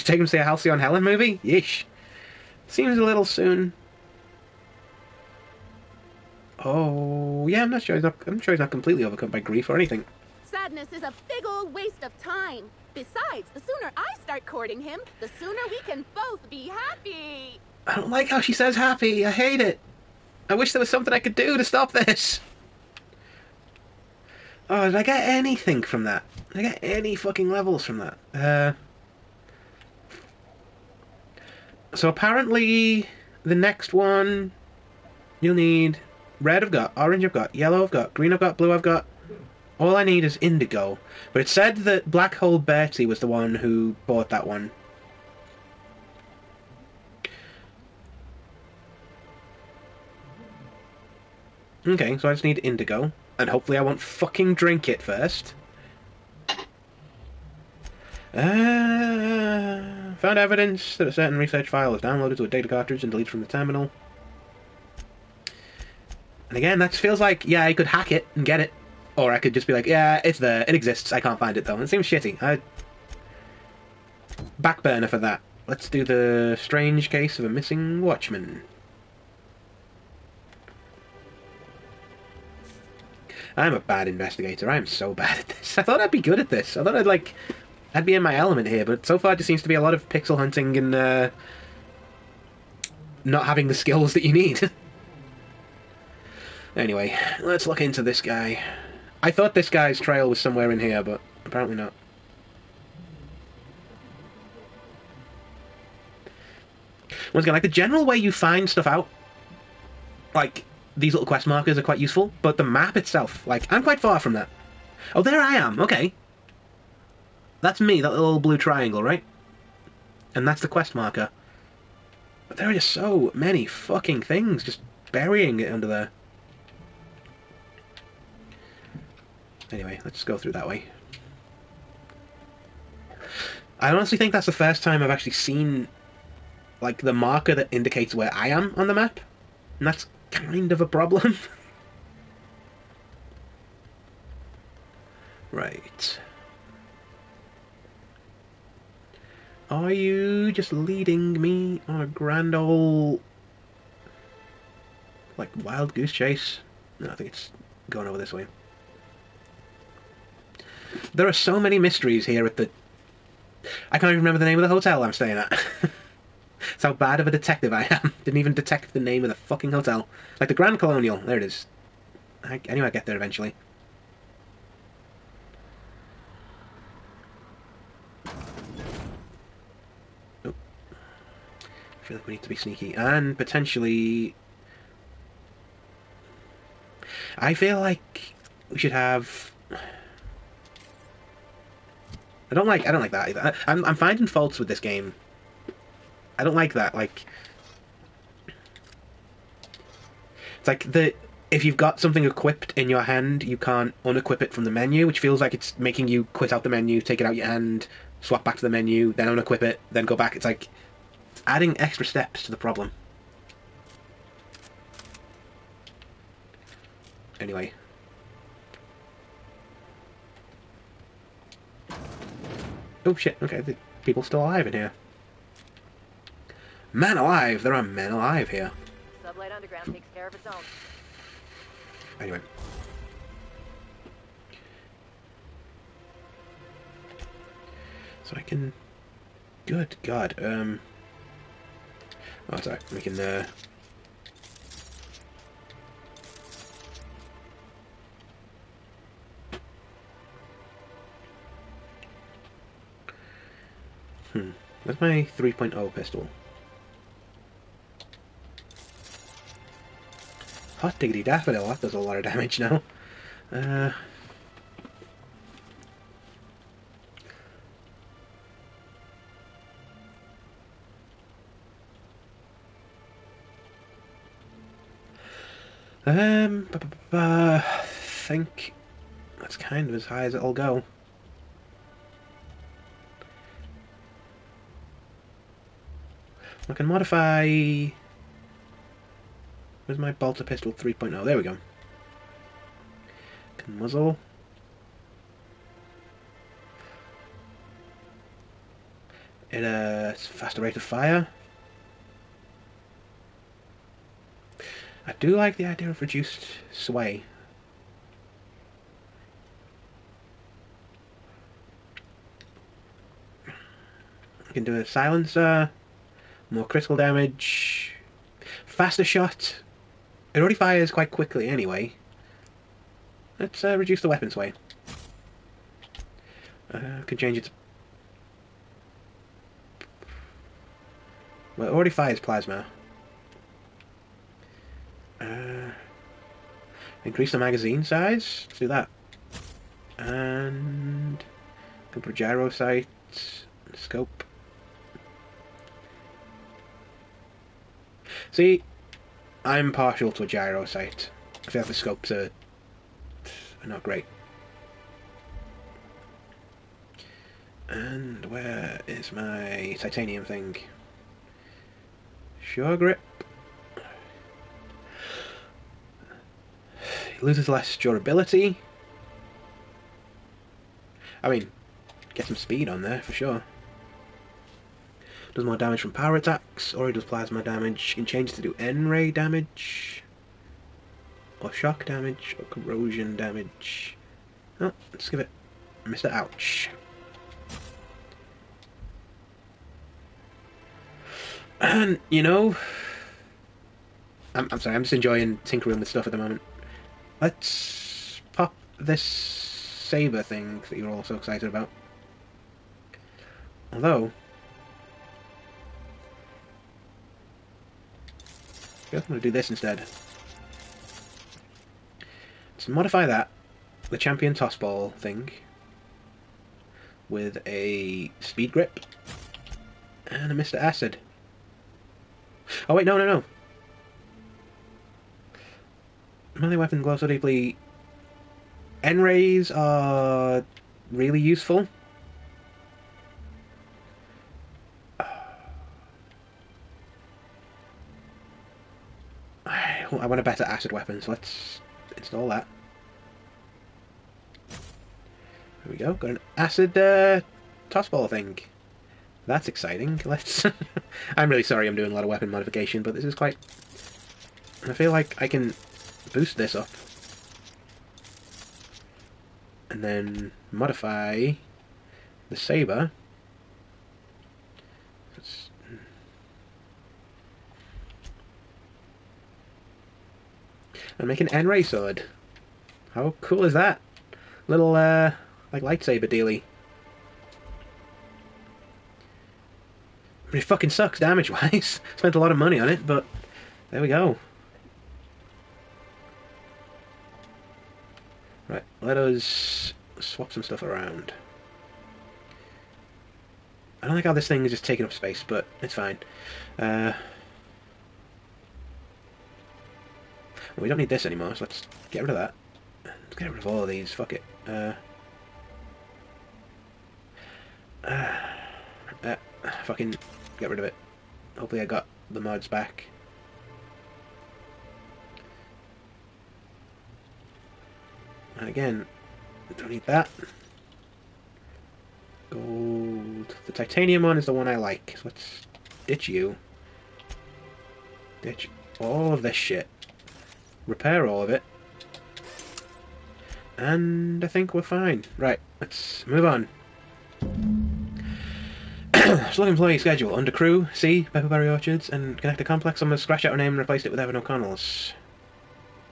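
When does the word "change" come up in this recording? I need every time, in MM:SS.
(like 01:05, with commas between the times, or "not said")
05:27, 06:18.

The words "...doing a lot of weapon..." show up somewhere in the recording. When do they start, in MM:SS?
07:31.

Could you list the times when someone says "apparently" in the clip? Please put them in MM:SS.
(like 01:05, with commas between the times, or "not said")
00:32, 01:41.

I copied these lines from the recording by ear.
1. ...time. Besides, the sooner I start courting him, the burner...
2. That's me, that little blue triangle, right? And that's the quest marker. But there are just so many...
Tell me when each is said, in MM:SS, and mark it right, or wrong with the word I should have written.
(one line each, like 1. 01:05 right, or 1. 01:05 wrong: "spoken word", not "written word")
1. 00:12 wrong: "sooner", not "burner"
2. 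01:57 right.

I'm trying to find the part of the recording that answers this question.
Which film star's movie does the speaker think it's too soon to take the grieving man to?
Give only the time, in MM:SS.
00:00.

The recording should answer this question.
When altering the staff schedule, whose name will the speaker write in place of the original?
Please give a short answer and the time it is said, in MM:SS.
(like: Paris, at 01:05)
Evan O'Connell, at 09:03.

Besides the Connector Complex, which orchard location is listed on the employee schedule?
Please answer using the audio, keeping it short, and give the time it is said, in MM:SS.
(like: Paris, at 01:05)
Pepperberry Orchards, at 09:01.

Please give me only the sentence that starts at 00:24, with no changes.
Oh, did I get anything from that?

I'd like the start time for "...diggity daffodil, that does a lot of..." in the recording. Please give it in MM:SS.
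04:20.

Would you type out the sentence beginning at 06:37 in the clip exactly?
Let's pop this saber thing that you're all so excited about.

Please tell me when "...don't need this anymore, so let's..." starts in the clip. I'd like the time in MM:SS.
08:20.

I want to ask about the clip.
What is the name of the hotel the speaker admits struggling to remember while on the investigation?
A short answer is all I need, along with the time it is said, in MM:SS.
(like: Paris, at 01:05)
Grand Colonial, at 02:50.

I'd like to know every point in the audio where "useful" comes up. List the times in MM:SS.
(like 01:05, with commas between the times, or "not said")
01:51, 07:11.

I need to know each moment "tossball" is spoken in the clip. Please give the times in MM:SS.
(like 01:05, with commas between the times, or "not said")
06:54, 07:27.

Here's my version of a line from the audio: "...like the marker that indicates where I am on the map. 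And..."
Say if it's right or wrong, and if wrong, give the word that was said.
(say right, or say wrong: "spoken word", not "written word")
right.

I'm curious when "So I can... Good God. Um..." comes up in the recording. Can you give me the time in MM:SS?
03:58.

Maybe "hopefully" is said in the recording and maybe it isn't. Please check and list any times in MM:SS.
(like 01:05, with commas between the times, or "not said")
00:53, 08:31.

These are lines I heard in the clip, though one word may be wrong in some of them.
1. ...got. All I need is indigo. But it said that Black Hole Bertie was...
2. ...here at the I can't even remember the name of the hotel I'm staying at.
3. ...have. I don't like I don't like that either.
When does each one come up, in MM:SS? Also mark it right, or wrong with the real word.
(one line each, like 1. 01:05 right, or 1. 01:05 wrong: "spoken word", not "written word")
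1. 00:38 right
2. 02:42 right
3. 03:08 right.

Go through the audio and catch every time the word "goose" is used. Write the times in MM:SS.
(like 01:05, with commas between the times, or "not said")
02:35.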